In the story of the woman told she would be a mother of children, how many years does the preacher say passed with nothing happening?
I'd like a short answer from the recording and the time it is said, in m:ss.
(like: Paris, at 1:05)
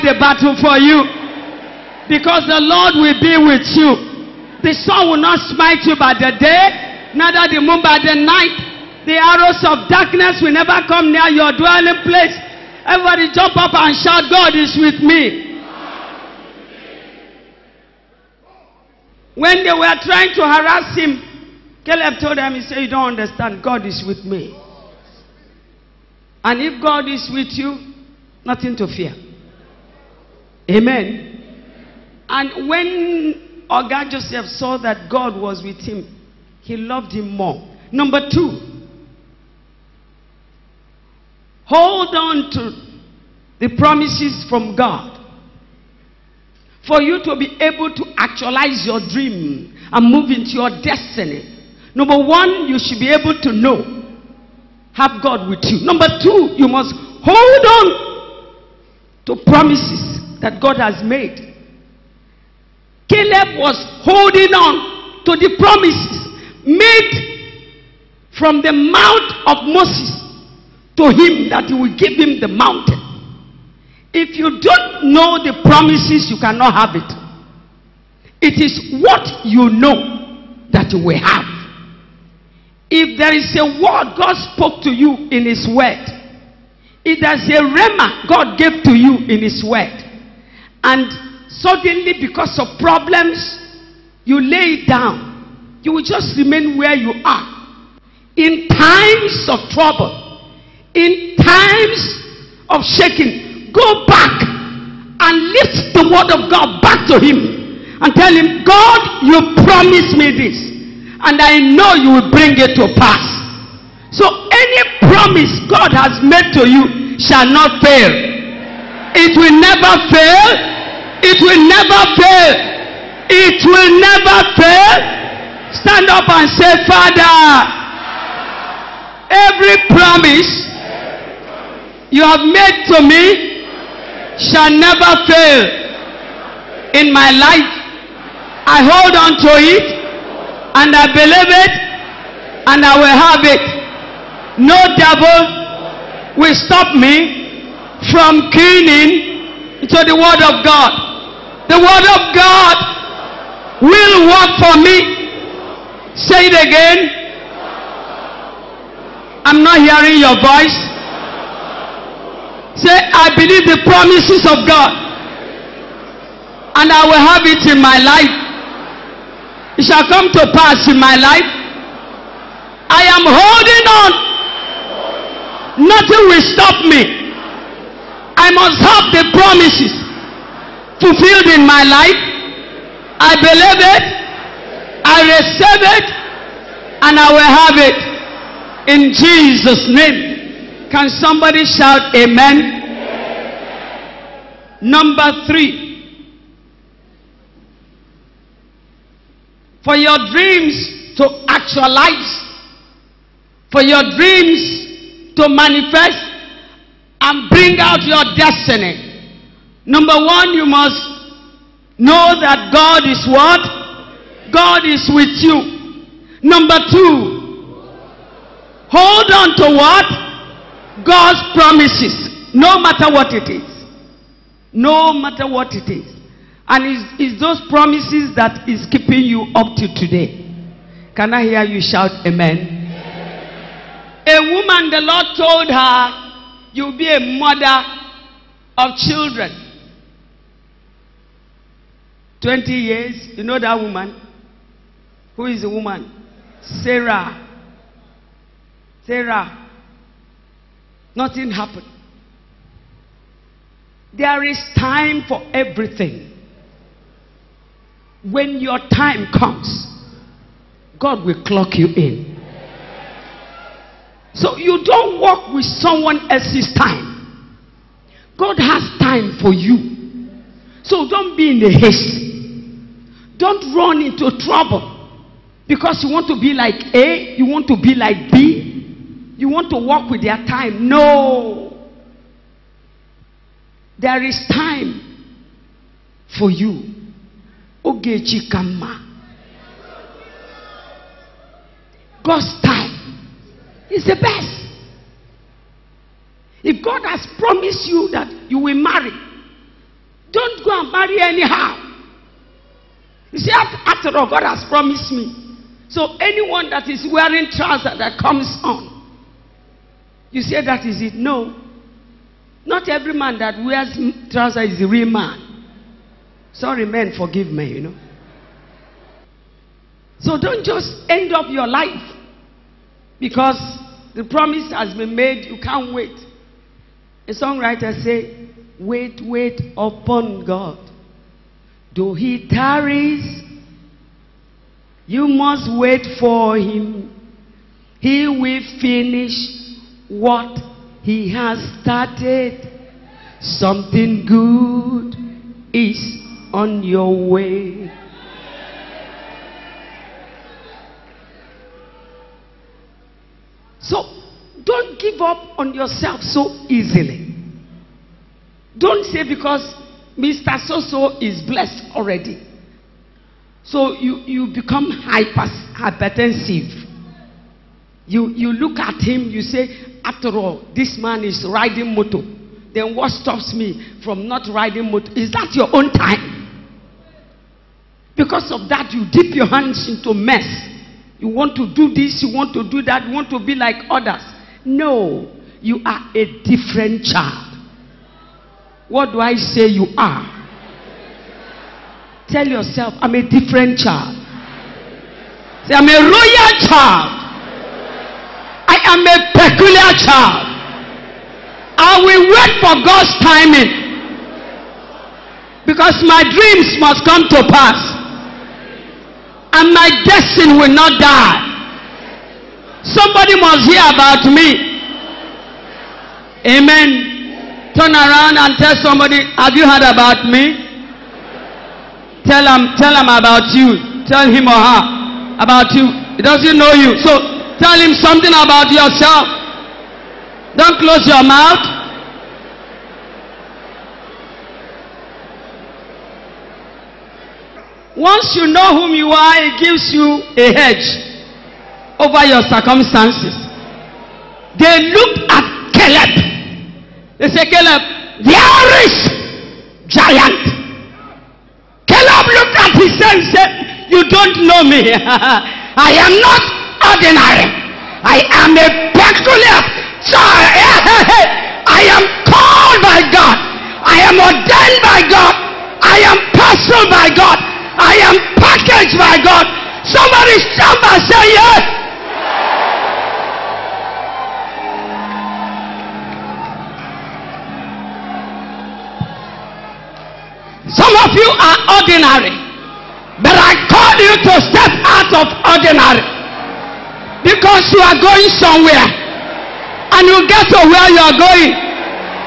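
20, at 4:02.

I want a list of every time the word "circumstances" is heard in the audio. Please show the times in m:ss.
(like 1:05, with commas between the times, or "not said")
7:22.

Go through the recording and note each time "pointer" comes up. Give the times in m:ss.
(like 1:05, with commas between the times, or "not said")
not said.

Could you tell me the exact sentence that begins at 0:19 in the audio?
When they were trying to harass him, Caleb told them, he said, You don't understand.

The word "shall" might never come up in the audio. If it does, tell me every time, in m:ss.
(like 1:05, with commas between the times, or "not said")
1:57, 2:14, 2:49.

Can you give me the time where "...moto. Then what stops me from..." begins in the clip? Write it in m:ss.
6:11.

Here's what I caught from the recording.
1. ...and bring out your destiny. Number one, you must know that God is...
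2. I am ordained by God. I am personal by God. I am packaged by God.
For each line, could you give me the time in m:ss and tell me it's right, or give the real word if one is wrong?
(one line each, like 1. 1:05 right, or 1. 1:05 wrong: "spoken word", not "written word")
1. 3:27 right
2. 7:43 right.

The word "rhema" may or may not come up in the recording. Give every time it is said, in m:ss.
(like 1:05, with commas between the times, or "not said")
1:27.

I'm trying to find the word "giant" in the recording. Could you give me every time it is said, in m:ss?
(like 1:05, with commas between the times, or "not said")
7:29.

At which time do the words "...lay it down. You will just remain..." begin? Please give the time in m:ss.
1:34.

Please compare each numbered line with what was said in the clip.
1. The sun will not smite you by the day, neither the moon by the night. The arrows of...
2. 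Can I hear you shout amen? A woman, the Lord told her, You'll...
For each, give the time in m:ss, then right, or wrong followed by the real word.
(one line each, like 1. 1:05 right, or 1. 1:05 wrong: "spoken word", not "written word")
1. 0:04 right
2. 3:51 right.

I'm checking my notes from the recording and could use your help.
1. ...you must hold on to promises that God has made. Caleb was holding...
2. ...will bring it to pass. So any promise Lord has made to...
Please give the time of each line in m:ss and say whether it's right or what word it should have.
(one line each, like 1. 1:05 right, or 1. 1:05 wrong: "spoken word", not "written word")
1. 0:56 right
2. 1:52 wrong: "God", not "Lord".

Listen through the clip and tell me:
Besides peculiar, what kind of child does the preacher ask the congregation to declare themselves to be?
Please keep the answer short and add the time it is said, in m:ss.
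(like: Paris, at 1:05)
royal, at 6:36.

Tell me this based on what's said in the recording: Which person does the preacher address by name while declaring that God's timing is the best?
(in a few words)
Ogechi.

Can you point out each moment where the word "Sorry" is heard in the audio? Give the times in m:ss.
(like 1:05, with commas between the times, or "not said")
5:16.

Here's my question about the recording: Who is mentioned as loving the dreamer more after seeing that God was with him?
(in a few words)
Oga Joseph.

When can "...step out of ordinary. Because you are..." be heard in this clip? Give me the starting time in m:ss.
8:04.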